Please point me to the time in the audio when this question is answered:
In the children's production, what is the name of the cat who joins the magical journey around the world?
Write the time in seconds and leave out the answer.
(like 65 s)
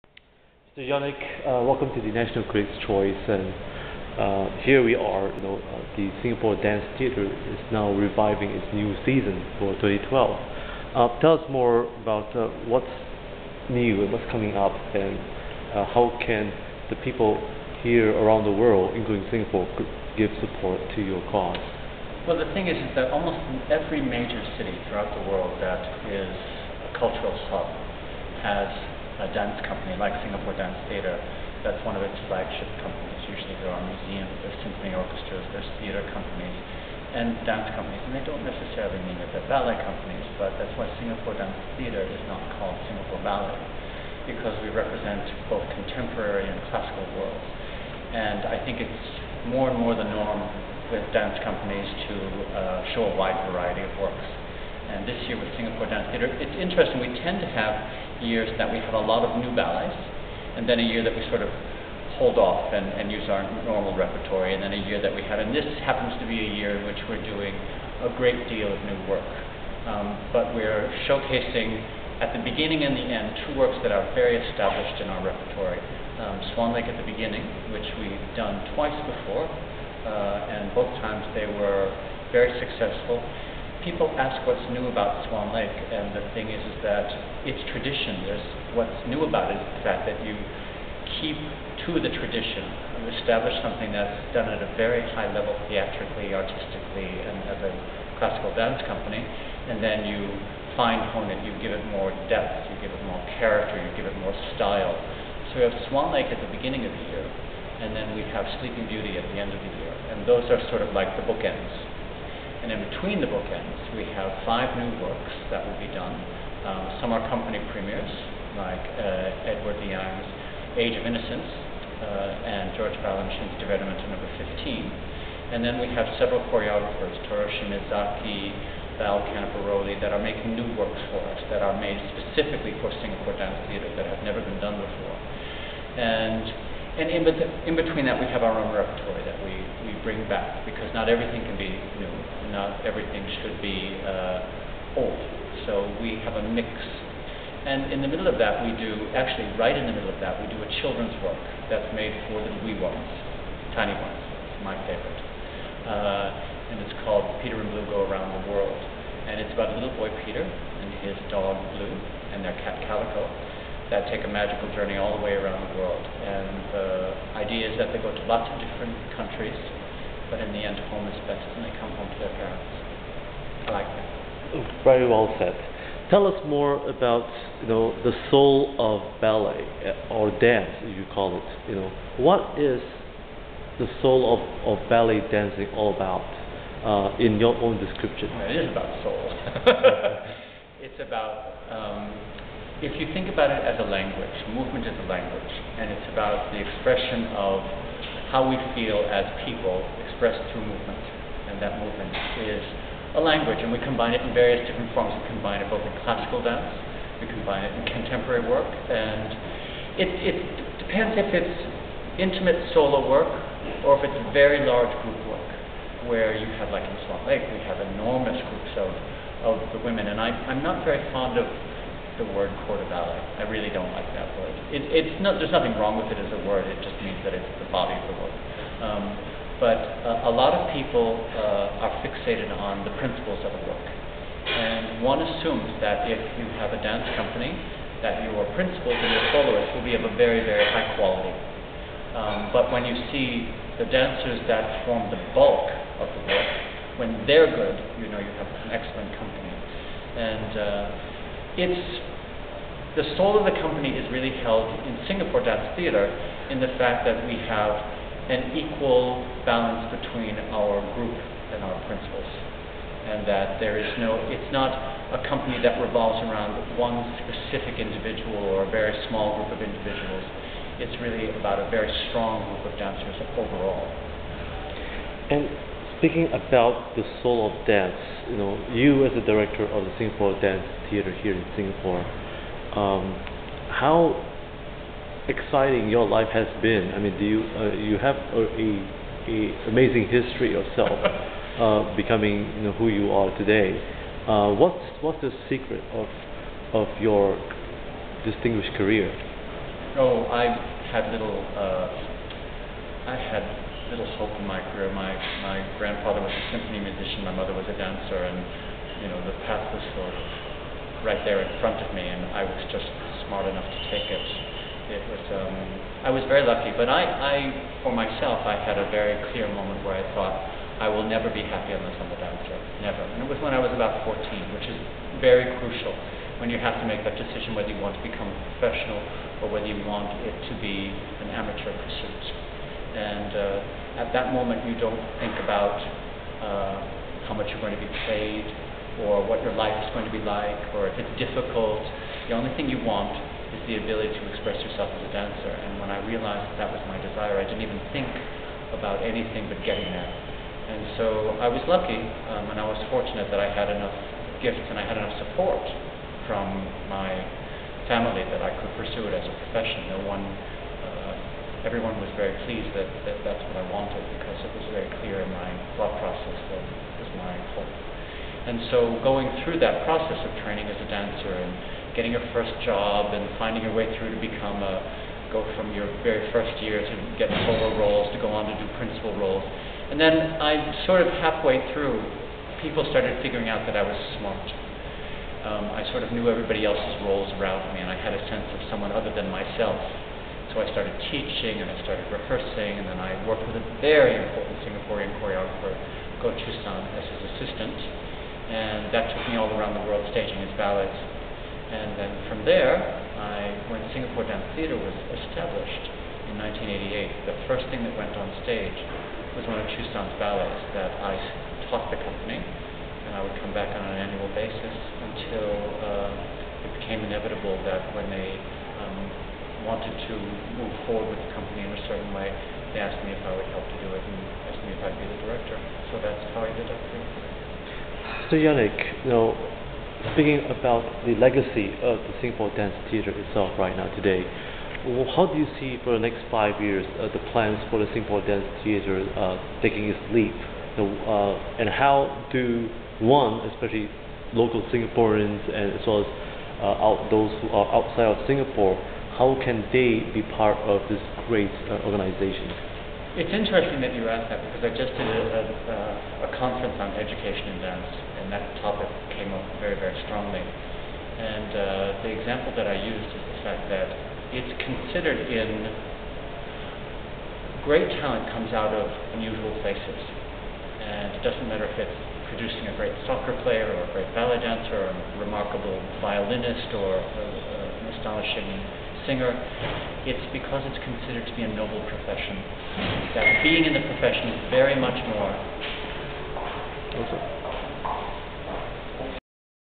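162 s.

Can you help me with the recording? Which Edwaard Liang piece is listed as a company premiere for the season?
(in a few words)
Age of Innocence.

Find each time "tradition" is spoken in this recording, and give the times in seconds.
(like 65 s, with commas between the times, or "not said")
87 s, 92 s.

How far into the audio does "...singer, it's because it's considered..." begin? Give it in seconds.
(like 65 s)
479 s.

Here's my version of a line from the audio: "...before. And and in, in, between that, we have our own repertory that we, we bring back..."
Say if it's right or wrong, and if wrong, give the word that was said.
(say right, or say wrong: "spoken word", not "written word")
right.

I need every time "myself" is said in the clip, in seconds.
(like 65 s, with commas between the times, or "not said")
317 s, 389 s.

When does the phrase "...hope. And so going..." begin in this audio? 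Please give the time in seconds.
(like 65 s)
367 s.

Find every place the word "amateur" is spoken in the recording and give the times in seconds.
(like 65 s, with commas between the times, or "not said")
331 s.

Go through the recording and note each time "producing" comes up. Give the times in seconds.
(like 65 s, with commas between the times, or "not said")
472 s.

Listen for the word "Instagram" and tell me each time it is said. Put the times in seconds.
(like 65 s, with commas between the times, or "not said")
not said.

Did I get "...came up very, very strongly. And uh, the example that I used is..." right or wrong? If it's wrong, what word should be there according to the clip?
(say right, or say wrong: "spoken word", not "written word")
right.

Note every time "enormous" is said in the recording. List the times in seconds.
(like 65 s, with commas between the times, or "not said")
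217 s.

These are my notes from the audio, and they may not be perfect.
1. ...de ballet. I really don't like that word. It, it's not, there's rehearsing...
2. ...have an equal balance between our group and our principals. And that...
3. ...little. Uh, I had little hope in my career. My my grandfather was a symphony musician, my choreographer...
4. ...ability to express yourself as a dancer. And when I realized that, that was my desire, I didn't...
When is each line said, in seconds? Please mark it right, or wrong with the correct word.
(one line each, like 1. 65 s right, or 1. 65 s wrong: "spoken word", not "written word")
1. 222 s wrong: "nothing", not "rehearsing"
2. 257 s right
3. 301 s wrong: "mother", not "choreographer"
4. 343 s right.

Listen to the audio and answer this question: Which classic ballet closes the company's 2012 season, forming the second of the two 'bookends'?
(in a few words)
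Sleeping Beauty.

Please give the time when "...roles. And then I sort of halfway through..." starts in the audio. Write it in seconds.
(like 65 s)
379 s.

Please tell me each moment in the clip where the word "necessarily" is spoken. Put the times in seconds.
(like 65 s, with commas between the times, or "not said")
38 s.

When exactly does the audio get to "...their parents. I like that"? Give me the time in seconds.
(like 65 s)
172 s.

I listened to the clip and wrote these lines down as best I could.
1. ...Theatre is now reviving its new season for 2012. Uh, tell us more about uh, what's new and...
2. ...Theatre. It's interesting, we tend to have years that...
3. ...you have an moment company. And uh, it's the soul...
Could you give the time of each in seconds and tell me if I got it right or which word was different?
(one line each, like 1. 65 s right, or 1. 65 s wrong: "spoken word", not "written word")
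1. 6 s right
2. 56 s right
3. 248 s wrong: "excellent", not "moment".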